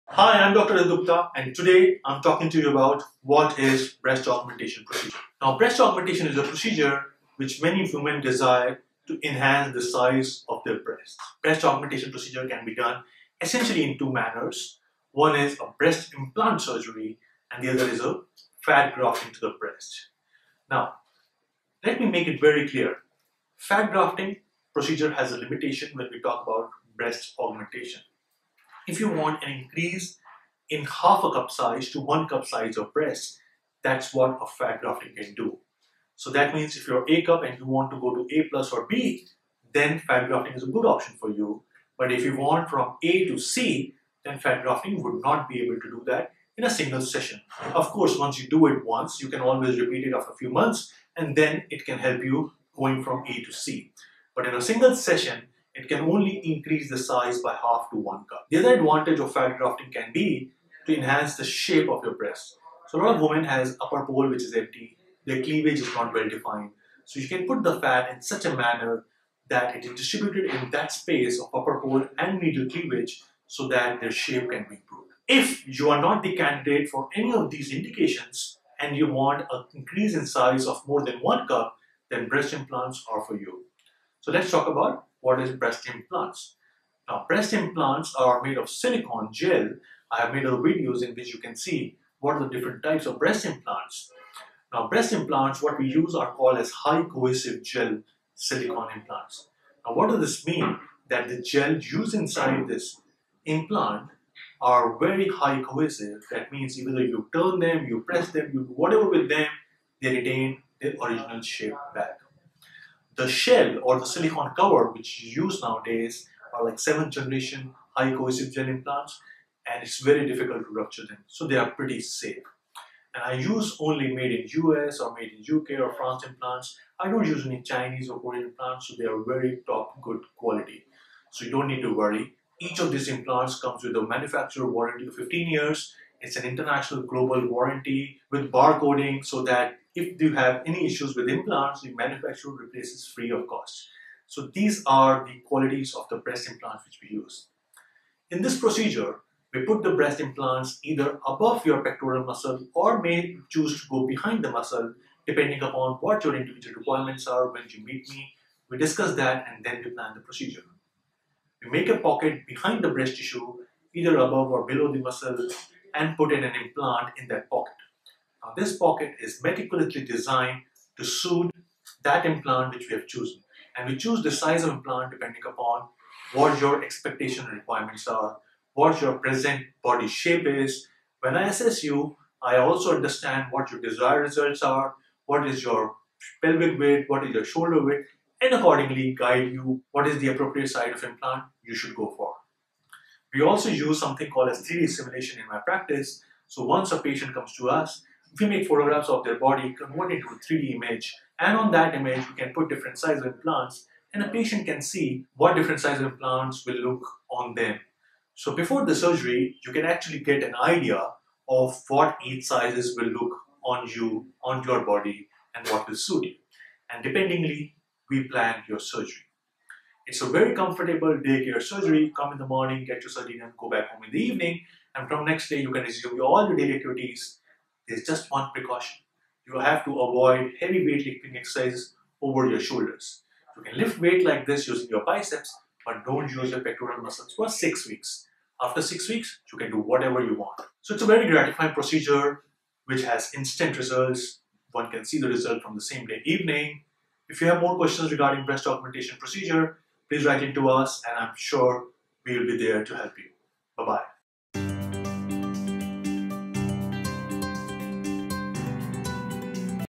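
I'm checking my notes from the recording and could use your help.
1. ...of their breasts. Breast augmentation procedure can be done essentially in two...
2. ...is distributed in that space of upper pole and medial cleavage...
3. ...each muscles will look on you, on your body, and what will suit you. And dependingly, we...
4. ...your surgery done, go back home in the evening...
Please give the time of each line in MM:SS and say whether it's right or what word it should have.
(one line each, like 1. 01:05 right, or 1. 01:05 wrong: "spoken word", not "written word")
1. 00:10 right
2. 01:09 right
3. 03:32 wrong: "sizes", not "muscles"
4. 03:43 right.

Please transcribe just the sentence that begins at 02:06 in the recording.
I don't use any Chinese or Korean implants, so they are very top good quality.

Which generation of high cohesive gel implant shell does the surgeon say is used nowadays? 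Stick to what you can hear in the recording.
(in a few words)
seventh generation.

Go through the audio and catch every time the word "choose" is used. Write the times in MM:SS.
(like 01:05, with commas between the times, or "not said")
02:33, 02:53.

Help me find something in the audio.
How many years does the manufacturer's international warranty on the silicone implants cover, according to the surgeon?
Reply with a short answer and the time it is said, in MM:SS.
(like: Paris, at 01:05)
15 years, at 02:15.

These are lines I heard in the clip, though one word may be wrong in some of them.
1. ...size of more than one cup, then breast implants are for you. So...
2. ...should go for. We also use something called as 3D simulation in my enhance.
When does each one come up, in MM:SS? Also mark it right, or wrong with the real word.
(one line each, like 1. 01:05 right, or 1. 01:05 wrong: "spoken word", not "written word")
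1. 01:20 right
2. 03:11 wrong: "practice", not "enhance".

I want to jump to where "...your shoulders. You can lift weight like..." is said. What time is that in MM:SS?
03:52.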